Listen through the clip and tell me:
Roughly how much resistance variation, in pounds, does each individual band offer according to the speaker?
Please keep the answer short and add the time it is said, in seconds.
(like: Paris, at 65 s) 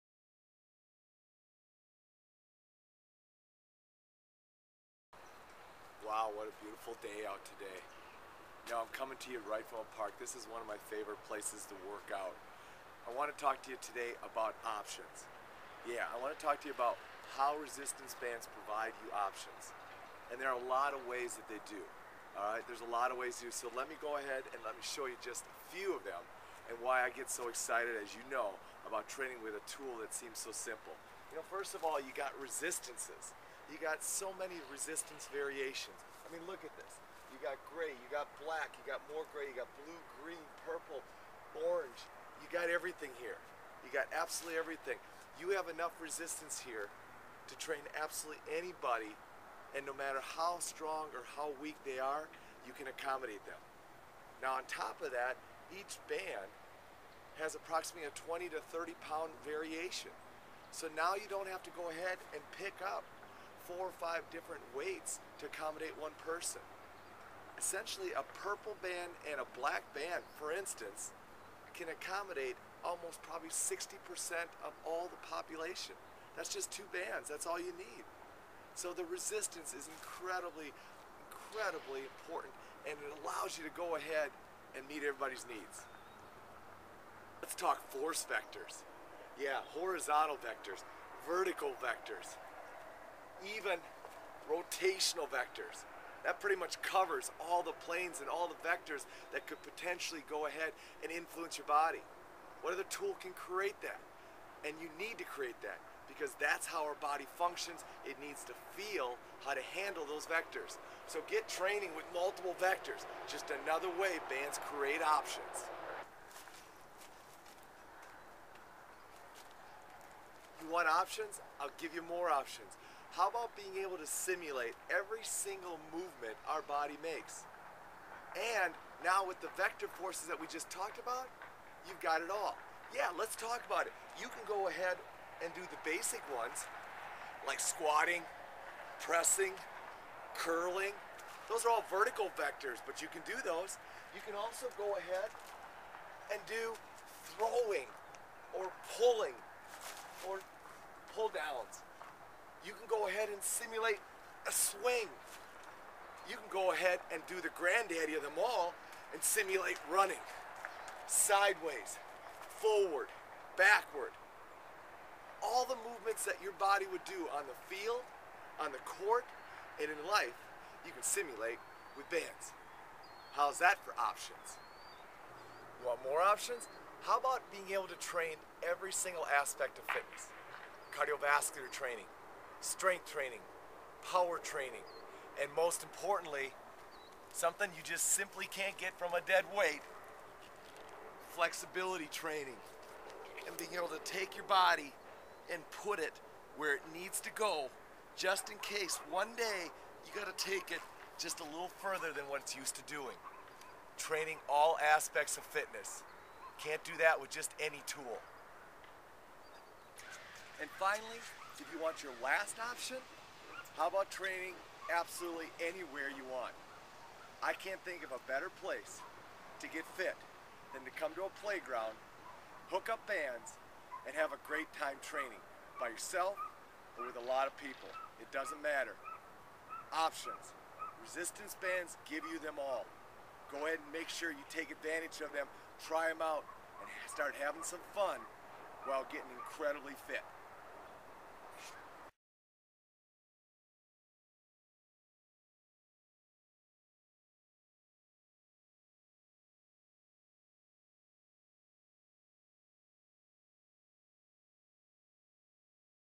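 20 to 30 pounds, at 58 s.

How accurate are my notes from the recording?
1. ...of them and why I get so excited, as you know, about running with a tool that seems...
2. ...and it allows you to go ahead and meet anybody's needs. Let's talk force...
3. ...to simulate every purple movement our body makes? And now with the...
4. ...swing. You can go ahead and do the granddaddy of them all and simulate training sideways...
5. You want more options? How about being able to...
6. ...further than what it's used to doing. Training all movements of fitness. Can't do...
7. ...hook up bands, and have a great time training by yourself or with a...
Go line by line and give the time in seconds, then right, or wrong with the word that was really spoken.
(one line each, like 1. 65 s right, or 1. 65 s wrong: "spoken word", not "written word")
1. 25 s wrong: "training", not "running"
2. 82 s wrong: "everybody", not "anybody"
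3. 123 s wrong: "single", not "purple"
4. 154 s wrong: "running", not "training"
5. 175 s right
6. 201 s wrong: "aspects", not "movements"
7. 222 s right.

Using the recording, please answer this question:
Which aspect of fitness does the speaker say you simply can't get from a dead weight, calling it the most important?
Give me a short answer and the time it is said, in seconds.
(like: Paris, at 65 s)
Flexibility training, at 191 s.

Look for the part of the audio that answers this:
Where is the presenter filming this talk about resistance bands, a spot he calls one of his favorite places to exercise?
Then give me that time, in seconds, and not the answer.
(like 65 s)
9 s.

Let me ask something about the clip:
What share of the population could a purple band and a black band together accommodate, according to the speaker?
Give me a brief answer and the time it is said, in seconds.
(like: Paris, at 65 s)
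60%, at 73 s.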